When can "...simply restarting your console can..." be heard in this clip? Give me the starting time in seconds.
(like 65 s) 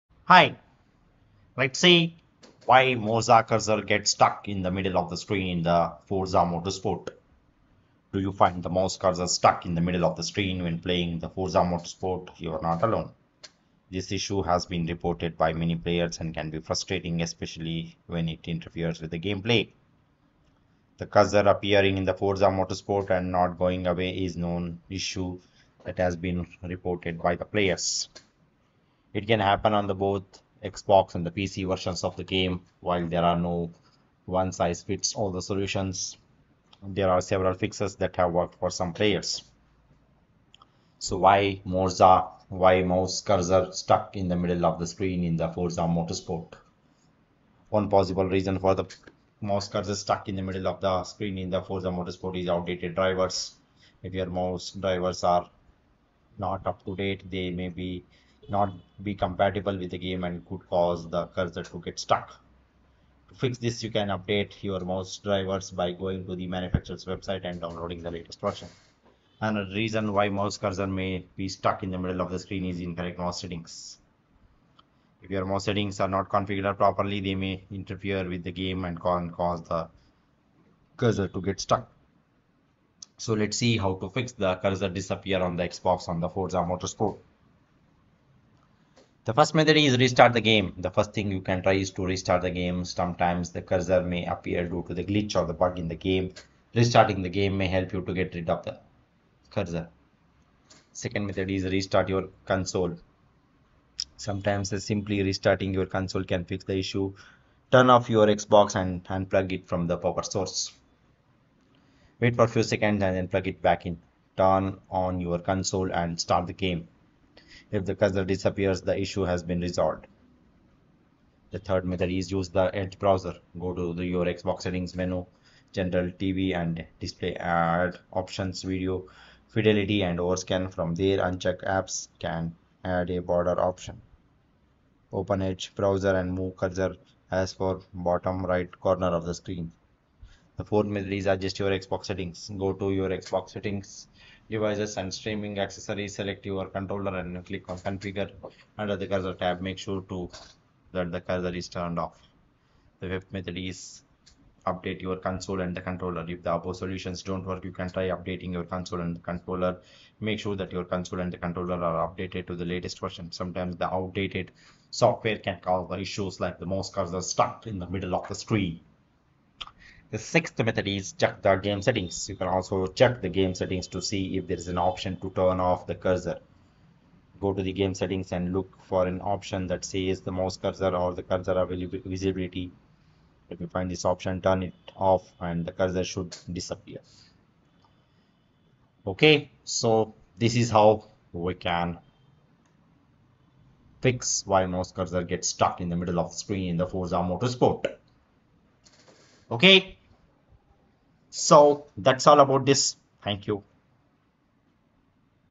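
104 s.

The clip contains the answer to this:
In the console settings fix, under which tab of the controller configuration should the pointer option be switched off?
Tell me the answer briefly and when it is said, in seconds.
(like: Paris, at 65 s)
Cursor tab, at 149 s.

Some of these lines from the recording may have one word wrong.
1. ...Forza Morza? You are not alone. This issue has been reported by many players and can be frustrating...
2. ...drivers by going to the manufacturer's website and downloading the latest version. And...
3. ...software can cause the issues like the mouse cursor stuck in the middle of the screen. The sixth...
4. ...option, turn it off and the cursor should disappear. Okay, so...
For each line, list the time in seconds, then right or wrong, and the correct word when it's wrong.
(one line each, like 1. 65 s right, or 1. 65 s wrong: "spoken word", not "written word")
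1. 11 s wrong: "Motorsport", not "Morza"
2. 65 s right
3. 164 s right
4. 184 s right.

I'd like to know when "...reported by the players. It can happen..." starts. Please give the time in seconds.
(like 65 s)
26 s.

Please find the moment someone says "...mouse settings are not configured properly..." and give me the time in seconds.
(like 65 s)
75 s.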